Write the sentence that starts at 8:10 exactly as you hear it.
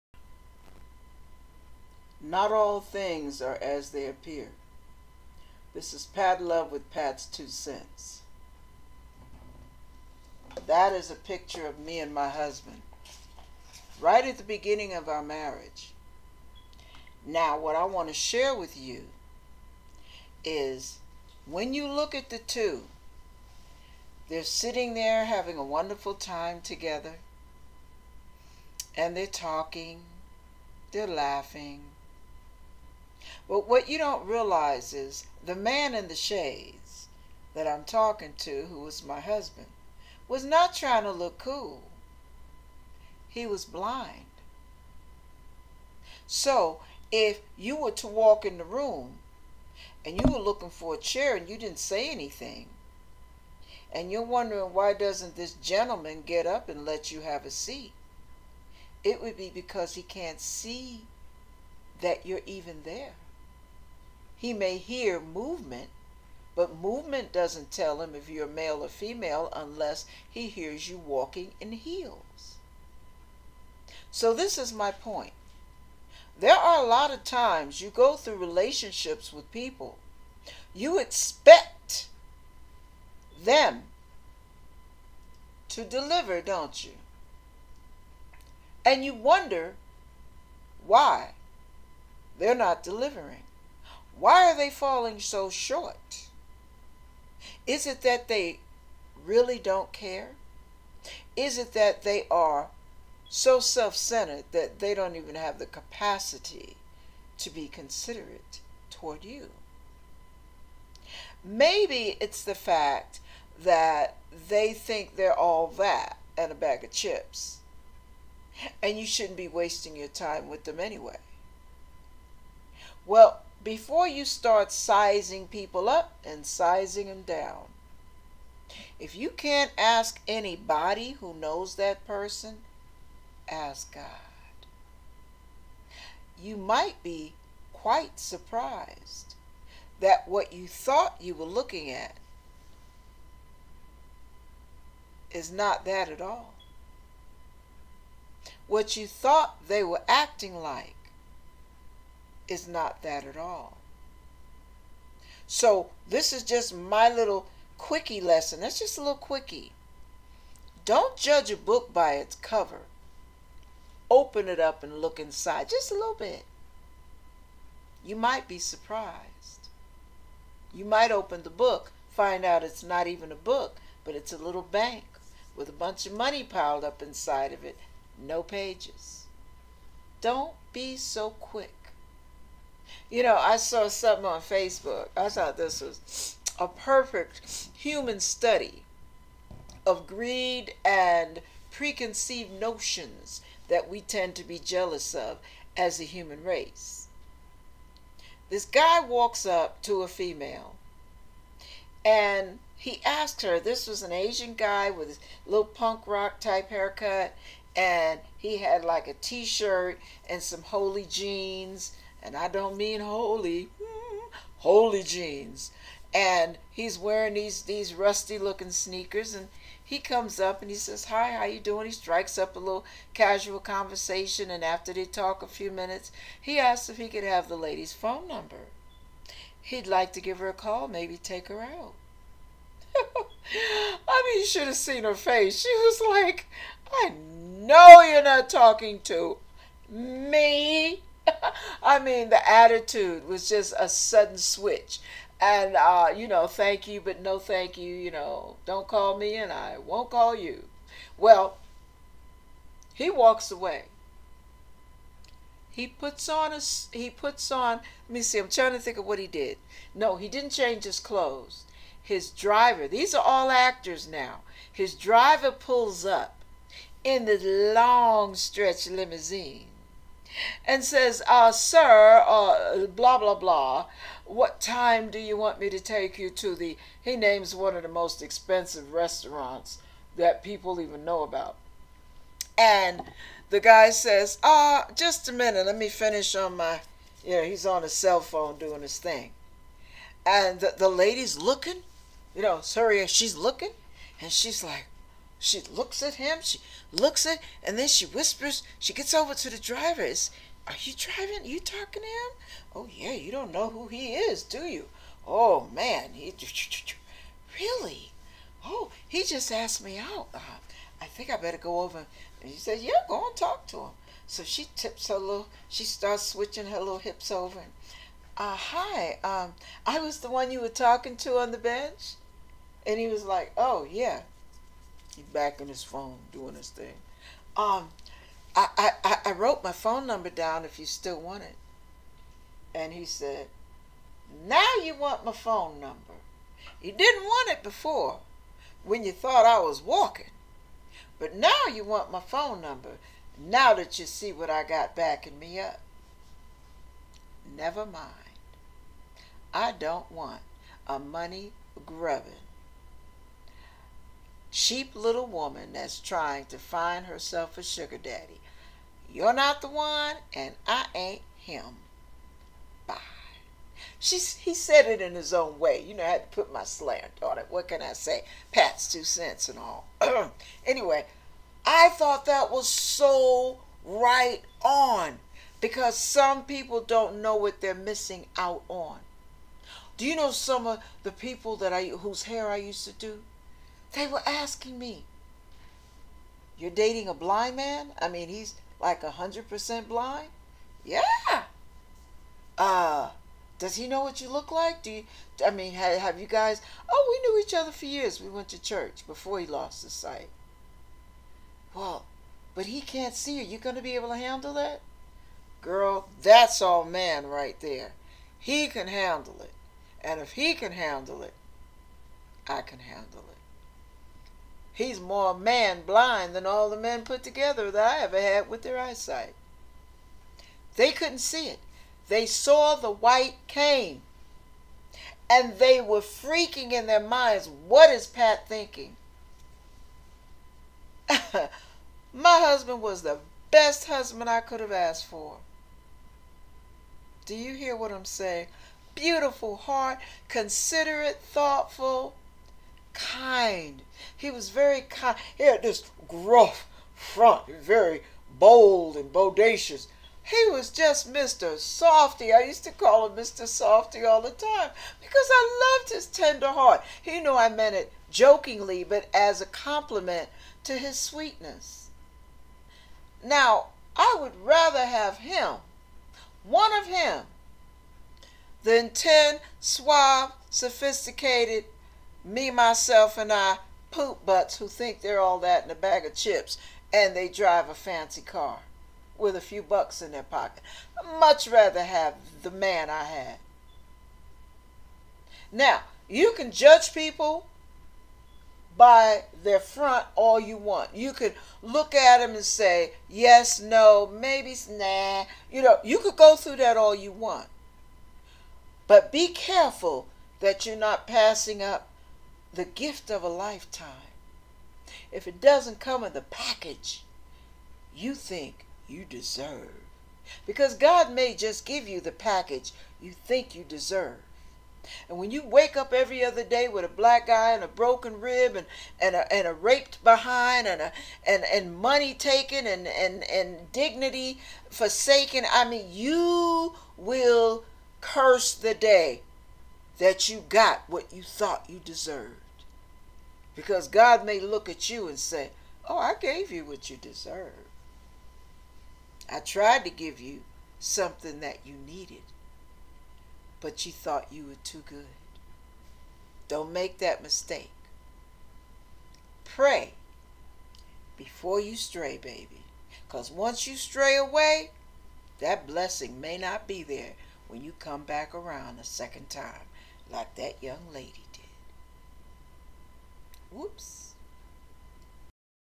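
You could look at them and say, yes, no, maybe, nah.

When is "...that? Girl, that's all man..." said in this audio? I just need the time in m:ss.
6:44.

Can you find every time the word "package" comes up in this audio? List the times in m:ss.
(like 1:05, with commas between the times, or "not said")
8:26, 8:32.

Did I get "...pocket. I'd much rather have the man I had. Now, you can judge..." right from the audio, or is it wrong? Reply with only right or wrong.
right.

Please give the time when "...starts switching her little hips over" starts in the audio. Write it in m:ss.
5:15.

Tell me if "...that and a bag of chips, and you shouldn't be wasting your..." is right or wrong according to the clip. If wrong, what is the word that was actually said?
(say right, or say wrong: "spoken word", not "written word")
right.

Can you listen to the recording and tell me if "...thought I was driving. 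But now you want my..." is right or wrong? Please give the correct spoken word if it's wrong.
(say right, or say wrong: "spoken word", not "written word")
wrong: "walking", not "driving".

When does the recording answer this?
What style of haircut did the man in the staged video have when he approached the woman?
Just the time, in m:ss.
3:25.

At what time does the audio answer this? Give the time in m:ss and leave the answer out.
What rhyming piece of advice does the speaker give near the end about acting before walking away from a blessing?
9:09.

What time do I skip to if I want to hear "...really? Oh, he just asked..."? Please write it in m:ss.
5:07.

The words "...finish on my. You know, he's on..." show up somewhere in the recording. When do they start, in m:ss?
4:45.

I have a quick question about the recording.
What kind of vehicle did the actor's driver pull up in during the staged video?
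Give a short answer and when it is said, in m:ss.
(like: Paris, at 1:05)
Stretch limousine, at 4:27.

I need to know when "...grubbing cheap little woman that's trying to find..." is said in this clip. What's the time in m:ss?
5:51.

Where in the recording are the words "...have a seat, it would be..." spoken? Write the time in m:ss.
0:57.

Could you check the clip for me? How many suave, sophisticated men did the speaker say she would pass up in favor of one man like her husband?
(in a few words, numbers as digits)
10.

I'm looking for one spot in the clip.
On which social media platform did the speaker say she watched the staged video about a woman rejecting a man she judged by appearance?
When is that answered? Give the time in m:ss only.
3:04.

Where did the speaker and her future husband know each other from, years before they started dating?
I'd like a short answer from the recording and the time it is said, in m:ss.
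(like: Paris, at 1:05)
Church, at 6:38.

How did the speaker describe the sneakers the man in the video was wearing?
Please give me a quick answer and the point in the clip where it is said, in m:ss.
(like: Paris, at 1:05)
Rusty looking, at 3:37.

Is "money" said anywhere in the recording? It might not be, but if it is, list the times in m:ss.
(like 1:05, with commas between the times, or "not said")
2:56, 5:50, 8:41.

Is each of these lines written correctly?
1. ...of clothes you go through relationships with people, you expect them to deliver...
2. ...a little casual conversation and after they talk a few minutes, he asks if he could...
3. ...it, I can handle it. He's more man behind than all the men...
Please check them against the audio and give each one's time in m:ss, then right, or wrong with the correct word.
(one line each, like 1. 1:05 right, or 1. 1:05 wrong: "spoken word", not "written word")
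1. 1:17 wrong: "times", not "clothes"
2. 3:42 right
3. 6:51 wrong: "blind", not "behind".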